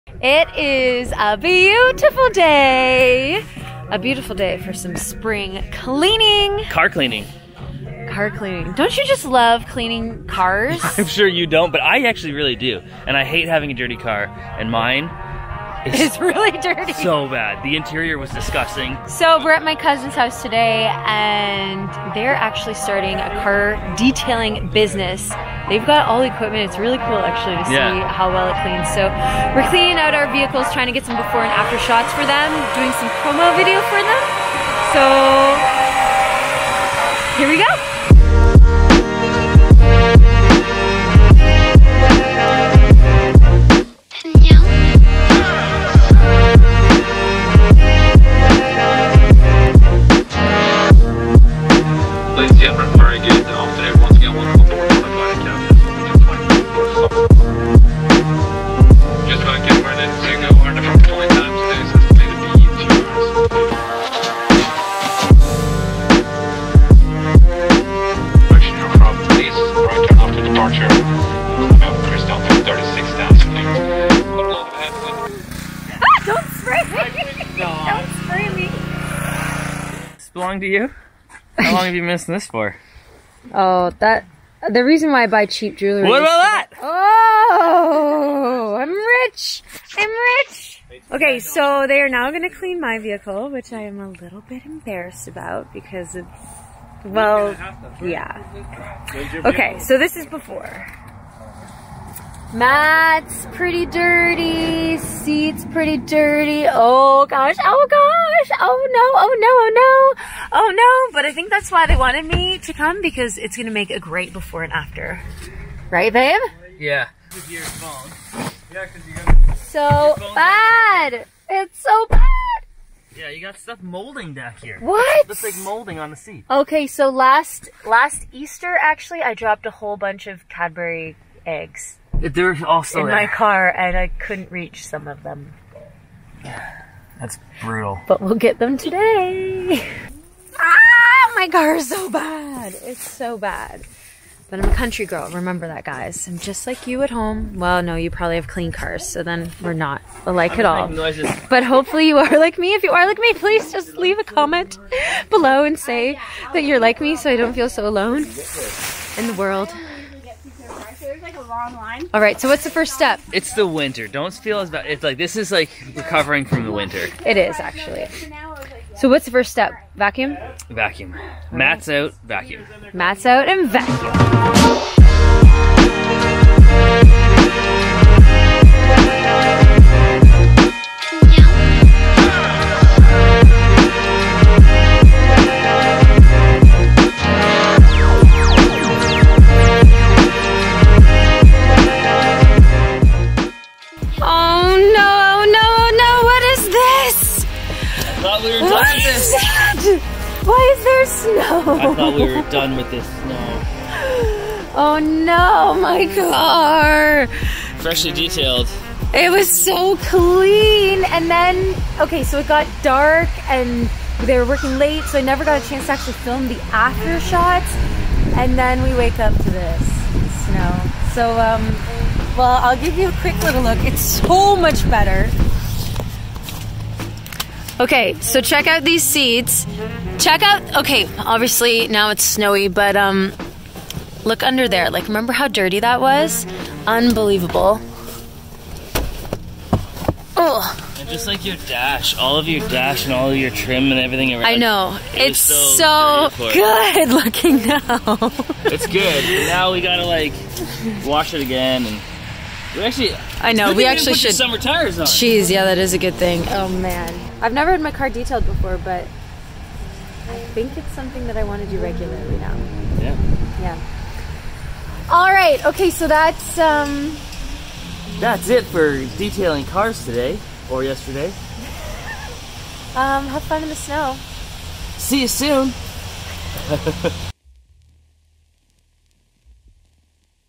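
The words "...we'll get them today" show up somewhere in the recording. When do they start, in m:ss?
2:18.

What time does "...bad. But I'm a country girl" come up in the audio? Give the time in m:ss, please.
2:23.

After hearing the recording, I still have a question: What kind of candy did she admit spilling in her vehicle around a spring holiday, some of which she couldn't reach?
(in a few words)
Cadbury eggs.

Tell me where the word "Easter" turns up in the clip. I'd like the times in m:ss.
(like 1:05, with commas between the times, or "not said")
2:08.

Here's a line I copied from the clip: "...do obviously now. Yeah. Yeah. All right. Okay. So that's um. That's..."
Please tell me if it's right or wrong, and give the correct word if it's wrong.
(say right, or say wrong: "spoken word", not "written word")
wrong: "regularly", not "obviously".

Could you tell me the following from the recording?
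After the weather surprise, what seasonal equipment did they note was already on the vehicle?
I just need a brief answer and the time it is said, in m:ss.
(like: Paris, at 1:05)
Summer tires, at 4:14.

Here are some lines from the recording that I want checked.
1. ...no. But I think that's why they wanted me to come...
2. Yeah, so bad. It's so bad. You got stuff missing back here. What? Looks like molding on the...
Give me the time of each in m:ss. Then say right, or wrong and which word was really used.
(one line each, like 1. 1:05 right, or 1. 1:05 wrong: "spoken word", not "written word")
1. 1:51 right
2. 1:57 wrong: "molding", not "missing".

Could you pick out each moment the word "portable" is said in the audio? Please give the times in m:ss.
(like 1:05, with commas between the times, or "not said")
not said.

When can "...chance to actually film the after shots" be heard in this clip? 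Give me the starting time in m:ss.
3:35.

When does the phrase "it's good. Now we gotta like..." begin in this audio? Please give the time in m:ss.
4:08.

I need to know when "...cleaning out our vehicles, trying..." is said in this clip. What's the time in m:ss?
0:29.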